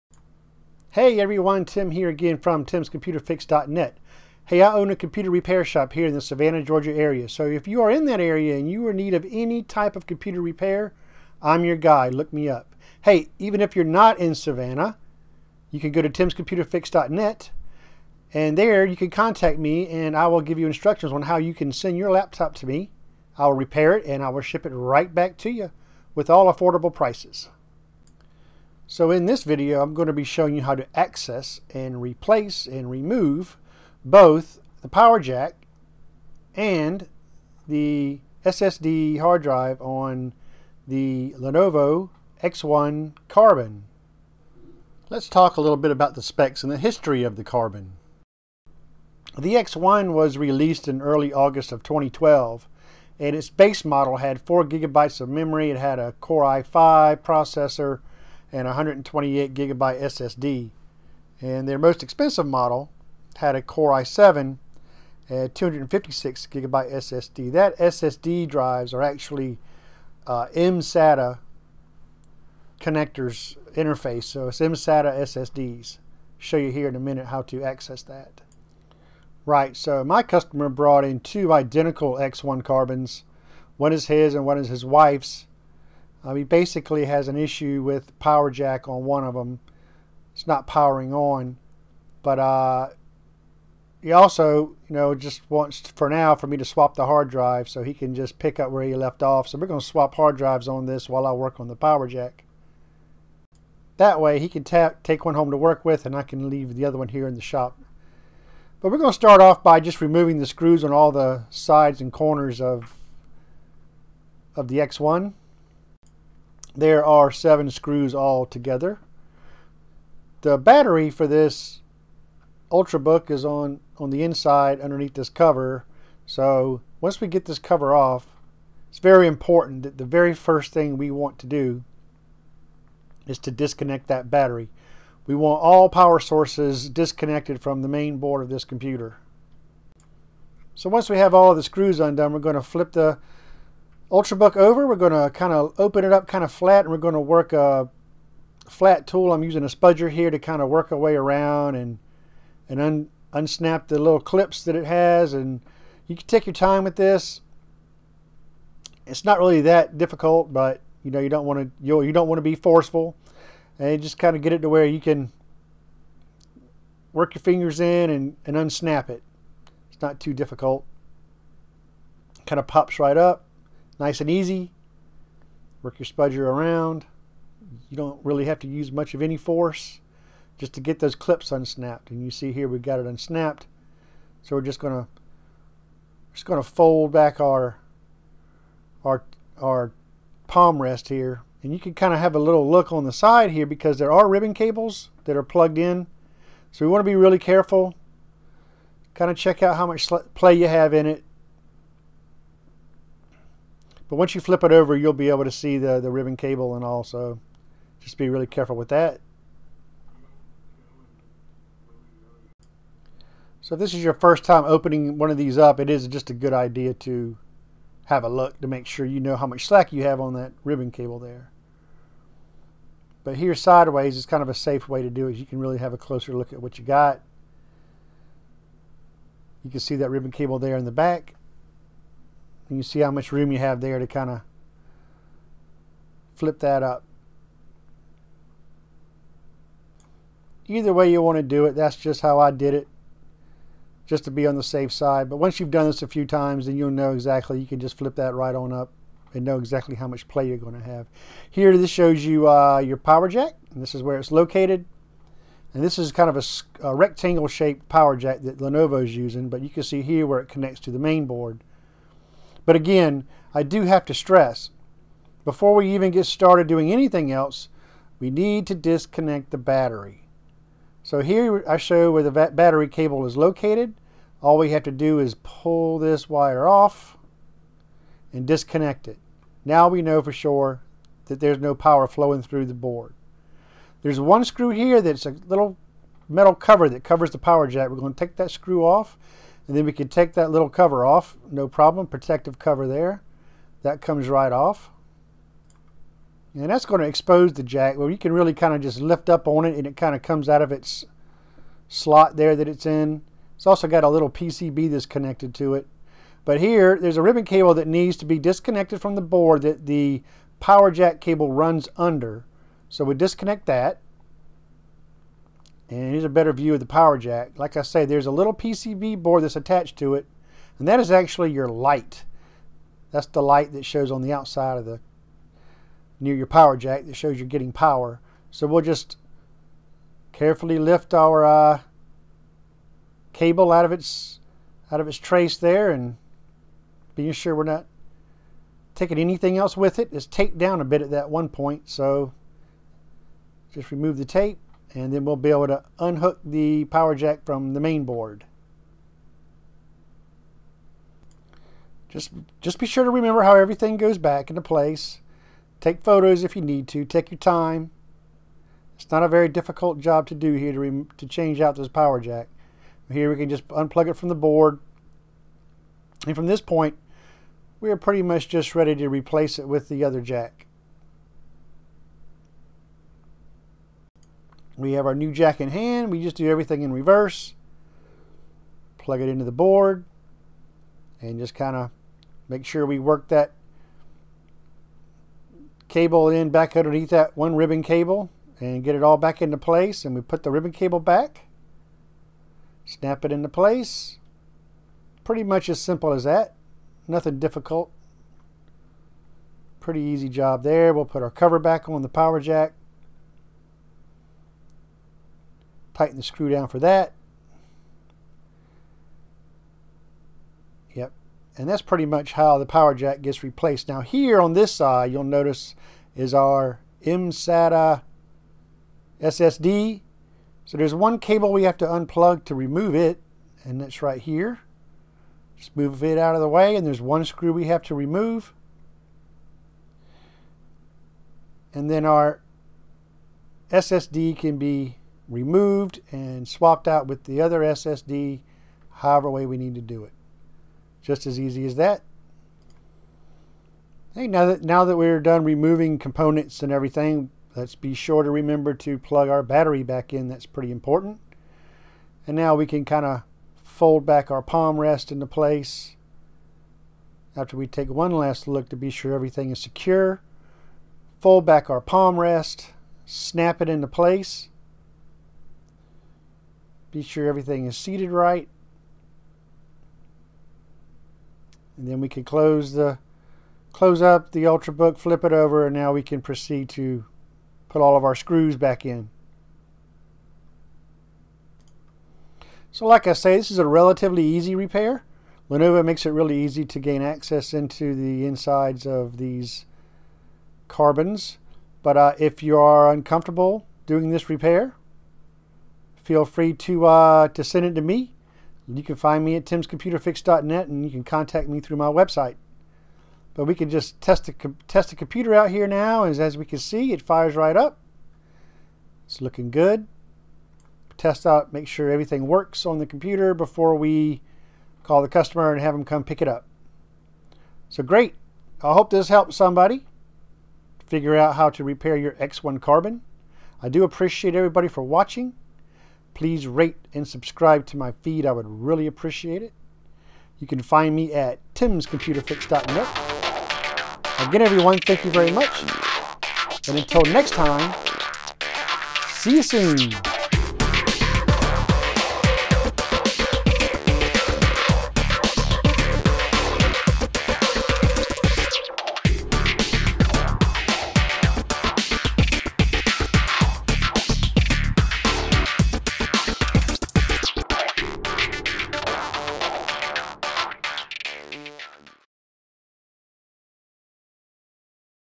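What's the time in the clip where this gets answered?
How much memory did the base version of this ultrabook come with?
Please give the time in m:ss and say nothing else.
0:54.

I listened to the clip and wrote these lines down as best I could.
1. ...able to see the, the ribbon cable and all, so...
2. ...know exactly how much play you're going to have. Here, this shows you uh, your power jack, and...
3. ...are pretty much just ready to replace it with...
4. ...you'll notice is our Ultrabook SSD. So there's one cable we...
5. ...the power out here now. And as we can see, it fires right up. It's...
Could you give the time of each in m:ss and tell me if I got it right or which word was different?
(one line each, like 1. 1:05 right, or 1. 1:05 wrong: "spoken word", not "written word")
1. 3:25 right
2. 4:09 right
3. 6:07 right
4. 6:55 wrong: "MSATA", not "Ultrabook"
5. 8:24 wrong: "computer", not "power".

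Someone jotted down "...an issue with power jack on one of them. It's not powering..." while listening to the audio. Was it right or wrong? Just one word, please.
right.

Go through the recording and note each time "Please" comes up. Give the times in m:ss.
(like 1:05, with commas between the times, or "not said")
8:46.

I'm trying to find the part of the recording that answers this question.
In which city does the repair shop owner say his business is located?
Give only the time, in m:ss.
0:06.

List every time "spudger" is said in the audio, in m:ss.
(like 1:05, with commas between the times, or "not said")
2:29, 2:56.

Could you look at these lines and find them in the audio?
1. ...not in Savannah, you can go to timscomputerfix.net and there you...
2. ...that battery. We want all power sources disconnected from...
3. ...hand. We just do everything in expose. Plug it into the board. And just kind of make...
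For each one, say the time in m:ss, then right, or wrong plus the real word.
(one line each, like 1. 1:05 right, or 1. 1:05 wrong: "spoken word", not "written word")
1. 0:13 right
2. 2:14 right
3. 6:15 wrong: "reverse", not "expose".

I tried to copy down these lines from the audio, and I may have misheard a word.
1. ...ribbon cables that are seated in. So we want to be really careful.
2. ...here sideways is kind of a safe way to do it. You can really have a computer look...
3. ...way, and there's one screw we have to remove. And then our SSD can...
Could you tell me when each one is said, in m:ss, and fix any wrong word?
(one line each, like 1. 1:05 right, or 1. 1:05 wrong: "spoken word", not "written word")
1. 3:14 wrong: "plugged", not "seated"
2. 3:43 wrong: "closer", not "computer"
3. 7:06 right.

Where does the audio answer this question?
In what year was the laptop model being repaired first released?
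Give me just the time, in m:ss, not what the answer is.
0:51.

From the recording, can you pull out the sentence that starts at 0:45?
Let's talk a little bit about the specs and the history of the Carbon.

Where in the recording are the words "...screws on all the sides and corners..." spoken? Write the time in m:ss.
1:50.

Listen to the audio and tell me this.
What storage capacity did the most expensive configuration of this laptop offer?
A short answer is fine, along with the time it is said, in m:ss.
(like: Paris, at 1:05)
256 gigabyte, at 1:05.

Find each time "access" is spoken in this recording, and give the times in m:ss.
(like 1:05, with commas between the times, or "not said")
0:30, 1:17, 8:07.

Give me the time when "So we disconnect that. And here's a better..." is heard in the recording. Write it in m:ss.
5:12.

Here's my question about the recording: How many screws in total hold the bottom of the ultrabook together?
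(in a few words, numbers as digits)
7.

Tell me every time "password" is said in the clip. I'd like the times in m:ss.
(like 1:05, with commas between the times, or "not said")
not said.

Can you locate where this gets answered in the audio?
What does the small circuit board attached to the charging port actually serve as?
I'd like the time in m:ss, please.
5:21.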